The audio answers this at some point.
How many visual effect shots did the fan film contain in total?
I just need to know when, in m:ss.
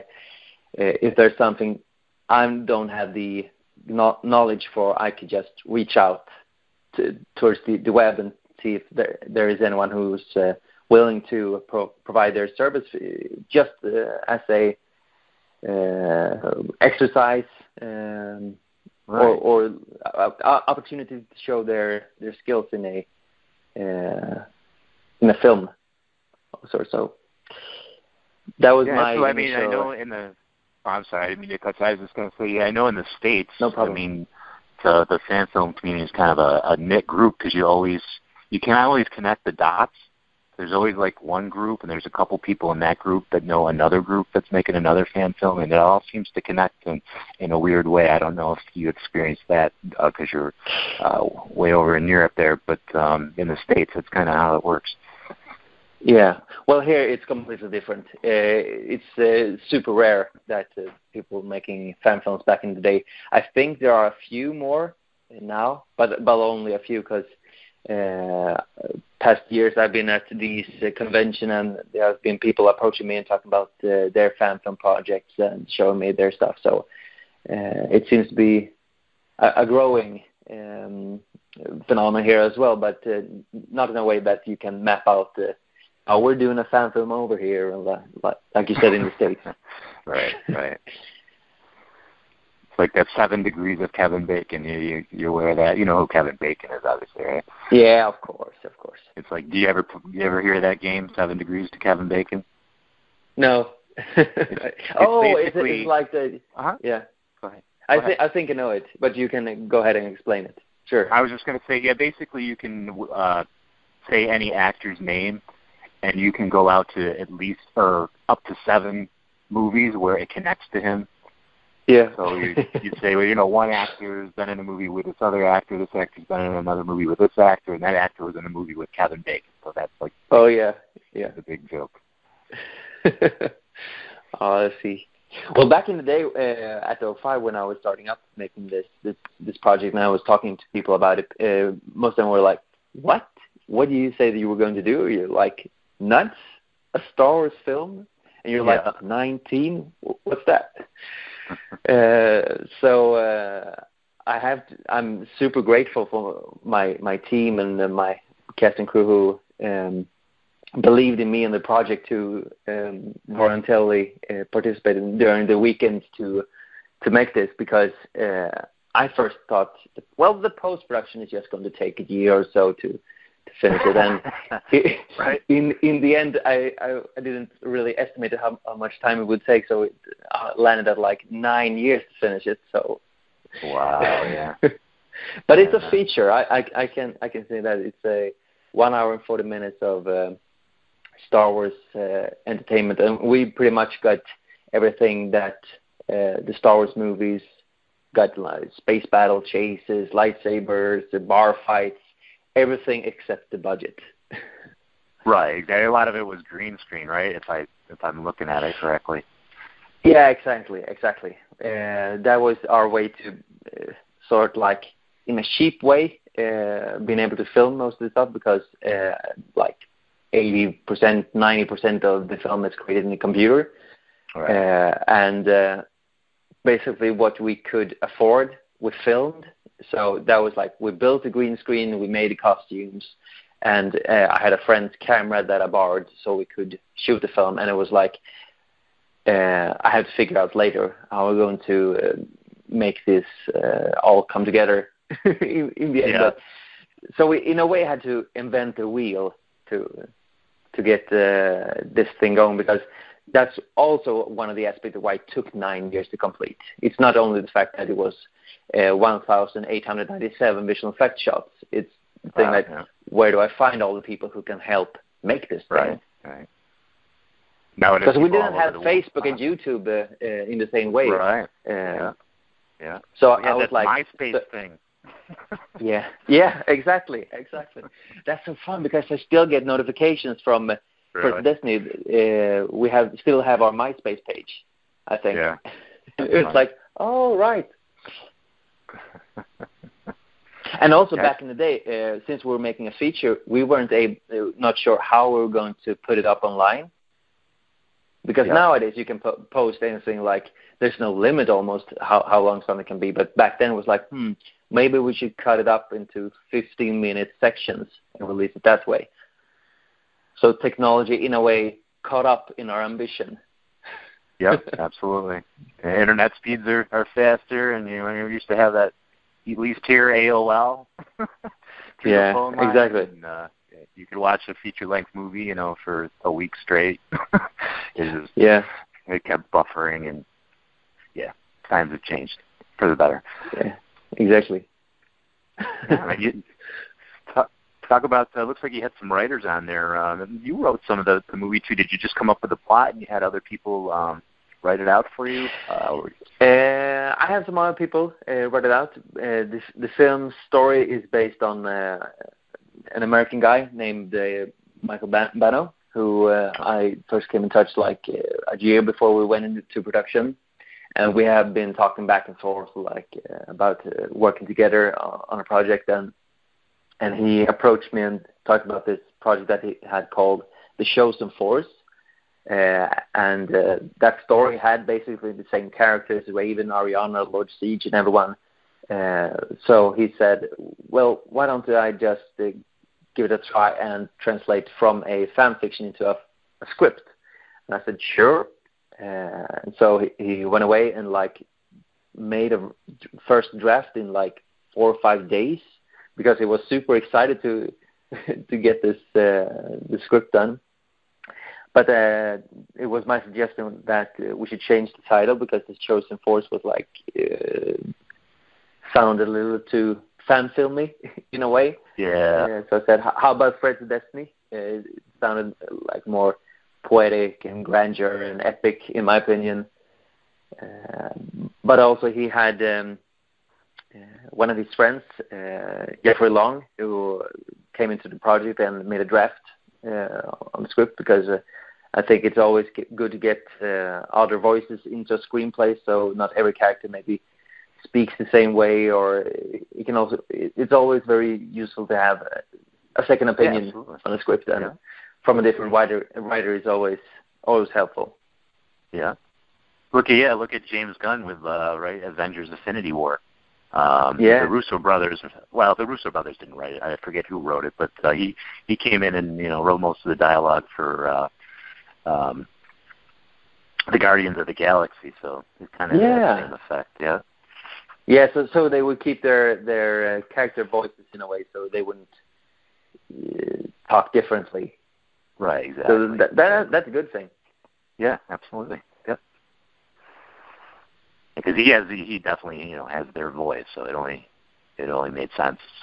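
4:18.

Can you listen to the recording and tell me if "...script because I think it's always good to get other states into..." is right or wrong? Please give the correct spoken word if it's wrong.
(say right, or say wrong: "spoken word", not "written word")
wrong: "voices", not "states".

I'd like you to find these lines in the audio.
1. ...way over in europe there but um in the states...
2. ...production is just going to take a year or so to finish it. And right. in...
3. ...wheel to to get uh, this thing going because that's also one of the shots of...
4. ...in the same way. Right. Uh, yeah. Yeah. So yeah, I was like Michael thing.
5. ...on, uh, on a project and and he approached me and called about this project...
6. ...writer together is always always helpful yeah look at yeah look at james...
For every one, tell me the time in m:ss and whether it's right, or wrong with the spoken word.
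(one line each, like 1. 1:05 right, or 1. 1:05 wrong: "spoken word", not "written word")
1. 0:51 right
2. 2:50 right
3. 4:08 wrong: "aspects", not "shots"
4. 4:30 wrong: "MySpace", not "Michael"
5. 6:04 wrong: "talked", not "called"
6. 7:25 wrong: "writer", not "together".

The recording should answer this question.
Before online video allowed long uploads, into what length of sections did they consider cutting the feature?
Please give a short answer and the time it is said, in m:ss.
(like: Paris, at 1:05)
15 minutes, at 5:06.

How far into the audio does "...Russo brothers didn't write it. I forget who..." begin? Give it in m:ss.
7:35.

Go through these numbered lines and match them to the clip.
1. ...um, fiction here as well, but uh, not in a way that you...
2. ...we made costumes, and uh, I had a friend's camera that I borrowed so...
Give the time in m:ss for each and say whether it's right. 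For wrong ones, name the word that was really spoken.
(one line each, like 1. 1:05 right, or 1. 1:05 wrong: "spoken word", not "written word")
1. 1:20 wrong: "phenomenon", not "fiction"
2. 3:51 right.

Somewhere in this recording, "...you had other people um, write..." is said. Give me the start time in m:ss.
5:42.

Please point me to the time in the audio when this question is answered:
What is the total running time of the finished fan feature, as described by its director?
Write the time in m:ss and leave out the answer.
3:08.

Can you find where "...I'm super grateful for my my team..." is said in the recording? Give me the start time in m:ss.
2:34.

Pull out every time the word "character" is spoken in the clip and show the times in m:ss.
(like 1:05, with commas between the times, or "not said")
6:15, 7:16, 7:50.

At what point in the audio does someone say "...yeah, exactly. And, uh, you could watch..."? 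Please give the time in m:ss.
5:22.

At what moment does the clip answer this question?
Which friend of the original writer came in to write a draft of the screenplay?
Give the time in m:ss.
7:06.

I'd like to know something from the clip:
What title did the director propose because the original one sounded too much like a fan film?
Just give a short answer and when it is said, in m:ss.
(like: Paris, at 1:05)
Threads Destiny, at 6:53.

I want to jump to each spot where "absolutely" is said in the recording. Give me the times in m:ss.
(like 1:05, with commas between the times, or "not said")
5:14, 7:58.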